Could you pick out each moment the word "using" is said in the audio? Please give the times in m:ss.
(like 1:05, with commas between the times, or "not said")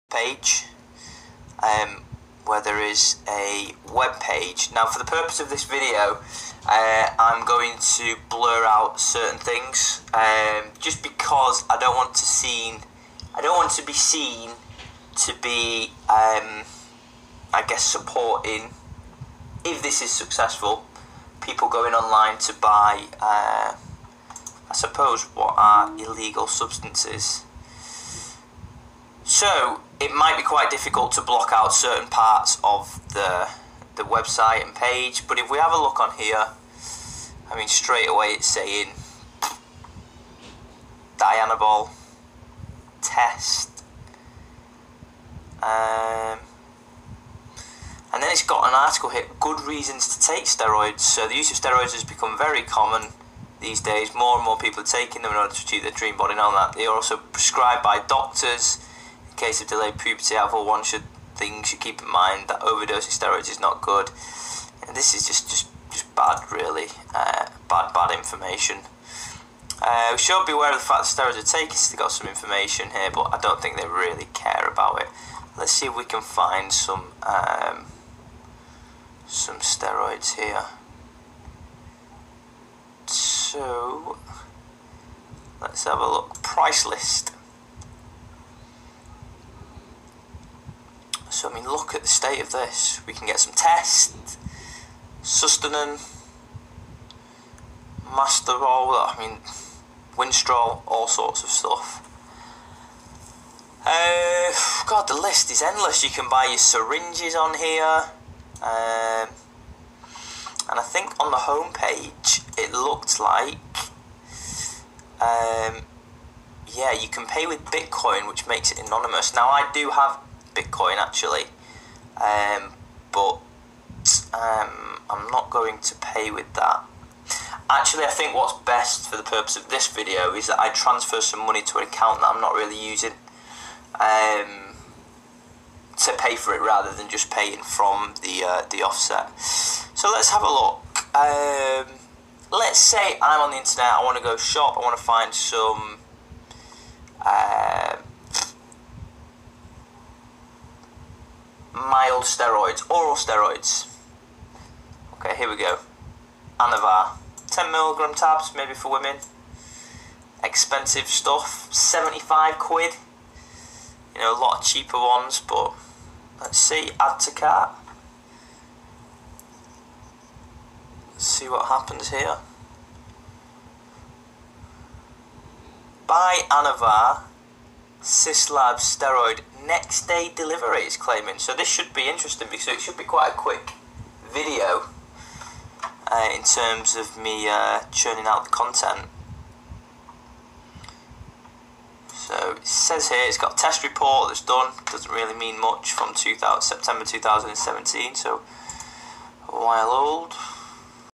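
2:12.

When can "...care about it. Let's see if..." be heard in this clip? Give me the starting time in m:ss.
1:14.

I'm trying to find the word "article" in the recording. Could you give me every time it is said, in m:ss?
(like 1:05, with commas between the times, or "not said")
0:48.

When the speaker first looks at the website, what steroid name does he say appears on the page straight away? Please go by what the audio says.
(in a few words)
Dianabol.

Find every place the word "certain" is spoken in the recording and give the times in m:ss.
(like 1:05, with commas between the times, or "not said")
0:08, 0:31.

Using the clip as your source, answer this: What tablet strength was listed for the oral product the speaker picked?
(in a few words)
10 milligram.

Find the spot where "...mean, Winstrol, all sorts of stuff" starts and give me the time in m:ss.
1:39.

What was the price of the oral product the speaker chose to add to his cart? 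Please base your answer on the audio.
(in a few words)
75 quid.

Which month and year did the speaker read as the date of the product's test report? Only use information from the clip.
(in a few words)
September 2017.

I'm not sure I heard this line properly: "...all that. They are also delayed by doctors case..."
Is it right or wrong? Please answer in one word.
wrong.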